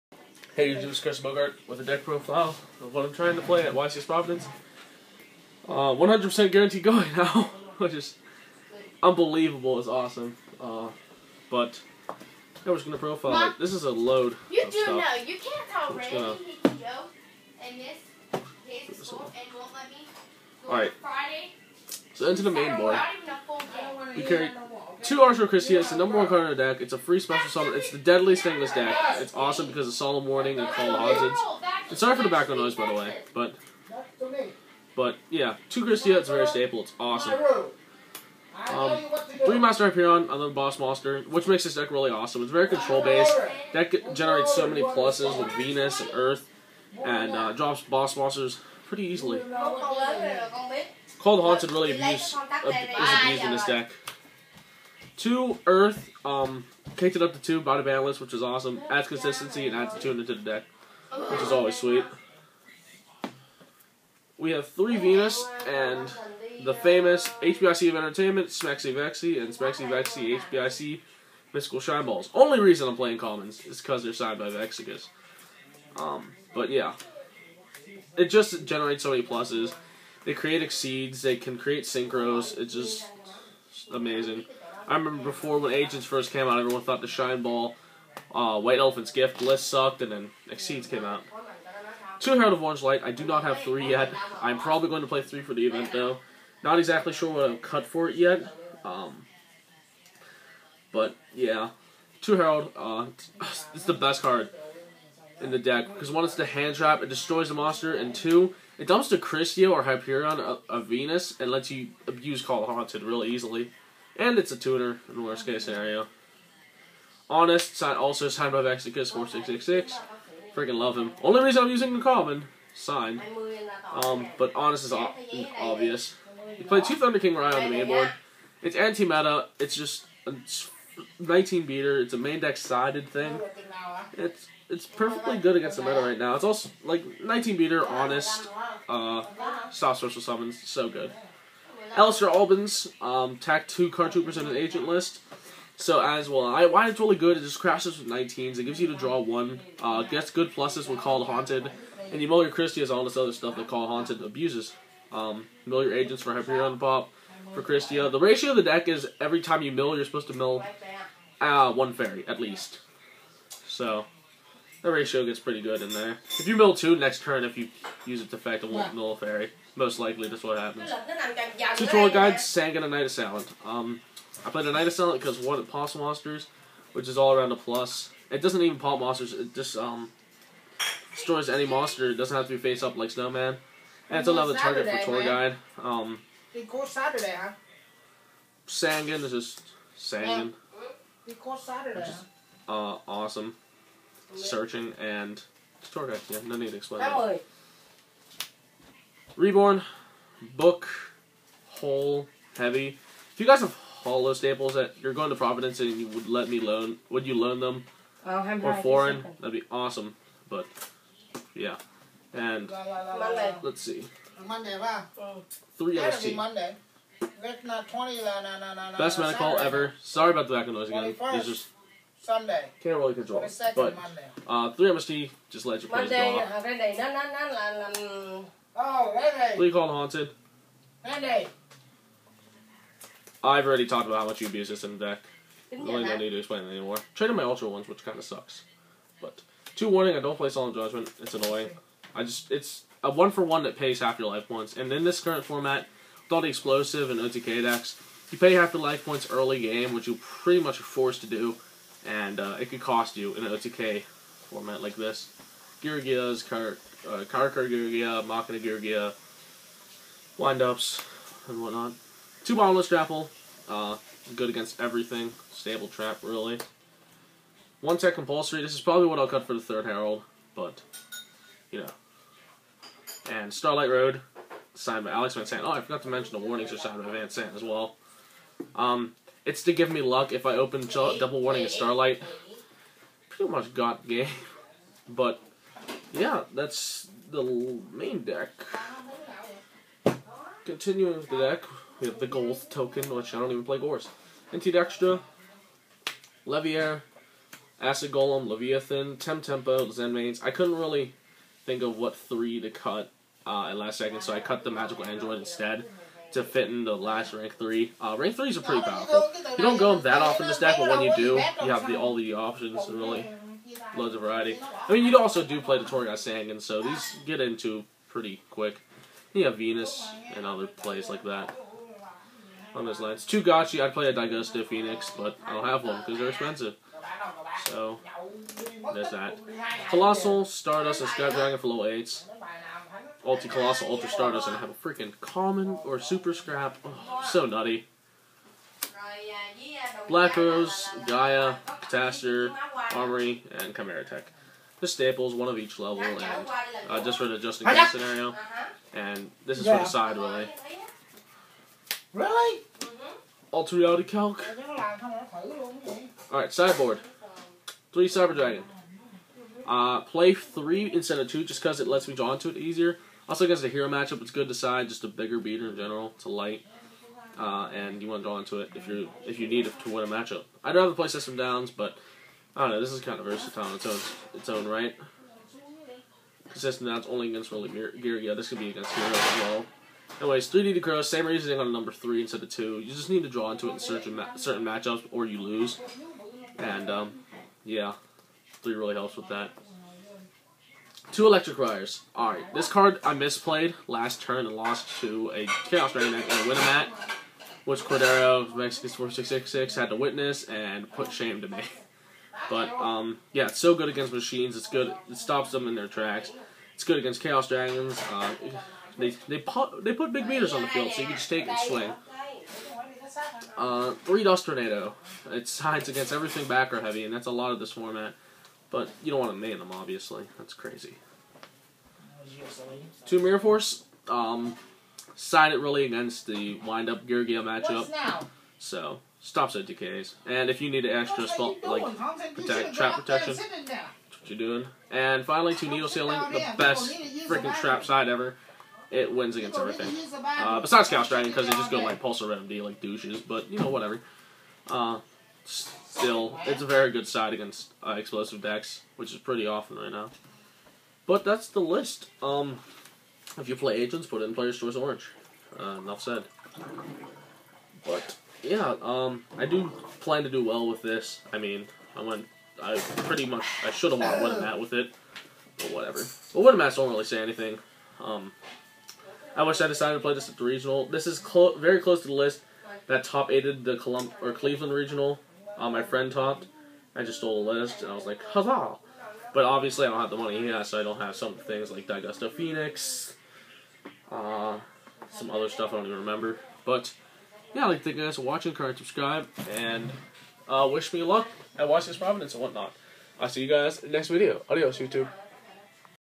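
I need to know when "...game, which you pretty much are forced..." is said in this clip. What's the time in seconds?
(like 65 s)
249 s.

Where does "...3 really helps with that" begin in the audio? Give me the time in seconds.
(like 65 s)
388 s.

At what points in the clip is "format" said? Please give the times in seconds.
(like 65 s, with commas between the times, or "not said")
245 s, 254 s, 417 s.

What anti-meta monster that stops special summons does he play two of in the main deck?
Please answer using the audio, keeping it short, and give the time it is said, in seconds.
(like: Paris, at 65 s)
Thunder King Rye, at 126 s.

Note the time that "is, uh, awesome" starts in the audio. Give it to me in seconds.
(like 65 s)
192 s.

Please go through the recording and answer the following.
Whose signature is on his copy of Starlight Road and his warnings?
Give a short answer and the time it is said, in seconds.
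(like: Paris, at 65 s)
Alex Van Sant, at 275 s.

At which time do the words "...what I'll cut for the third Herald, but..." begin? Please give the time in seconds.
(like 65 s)
269 s.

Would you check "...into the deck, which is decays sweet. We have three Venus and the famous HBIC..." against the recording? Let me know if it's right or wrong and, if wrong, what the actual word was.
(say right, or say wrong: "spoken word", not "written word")
wrong: "always", not "decays".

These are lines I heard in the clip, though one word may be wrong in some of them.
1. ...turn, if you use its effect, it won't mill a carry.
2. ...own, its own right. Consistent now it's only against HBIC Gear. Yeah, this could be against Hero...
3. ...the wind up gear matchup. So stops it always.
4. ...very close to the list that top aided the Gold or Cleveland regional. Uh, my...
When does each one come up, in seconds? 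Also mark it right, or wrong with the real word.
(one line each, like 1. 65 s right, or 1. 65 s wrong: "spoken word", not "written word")
1. 167 s wrong: "fairy", not "carry"
2. 373 s wrong: "Rolling", not "HBIC"
3. 426 s wrong: "decays", not "always"
4. 471 s wrong: "Colum", not "Gold".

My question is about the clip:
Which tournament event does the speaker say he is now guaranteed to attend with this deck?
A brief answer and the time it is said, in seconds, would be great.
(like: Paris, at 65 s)
YCS Providence, at 3 s.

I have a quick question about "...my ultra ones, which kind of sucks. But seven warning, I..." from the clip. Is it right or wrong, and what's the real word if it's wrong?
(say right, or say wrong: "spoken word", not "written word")
wrong: "two", not "seven".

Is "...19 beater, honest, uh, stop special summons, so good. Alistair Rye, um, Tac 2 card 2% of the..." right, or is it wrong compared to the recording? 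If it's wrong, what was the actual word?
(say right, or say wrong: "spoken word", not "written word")
wrong: "Albans", not "Rye".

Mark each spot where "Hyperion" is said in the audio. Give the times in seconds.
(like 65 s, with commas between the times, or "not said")
39 s, 109 s, 156 s.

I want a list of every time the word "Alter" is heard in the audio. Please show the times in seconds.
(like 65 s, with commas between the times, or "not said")
353 s.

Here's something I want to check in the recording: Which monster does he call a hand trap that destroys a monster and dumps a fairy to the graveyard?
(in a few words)
Herald of Orange Light.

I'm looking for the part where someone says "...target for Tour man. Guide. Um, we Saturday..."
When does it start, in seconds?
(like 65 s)
184 s.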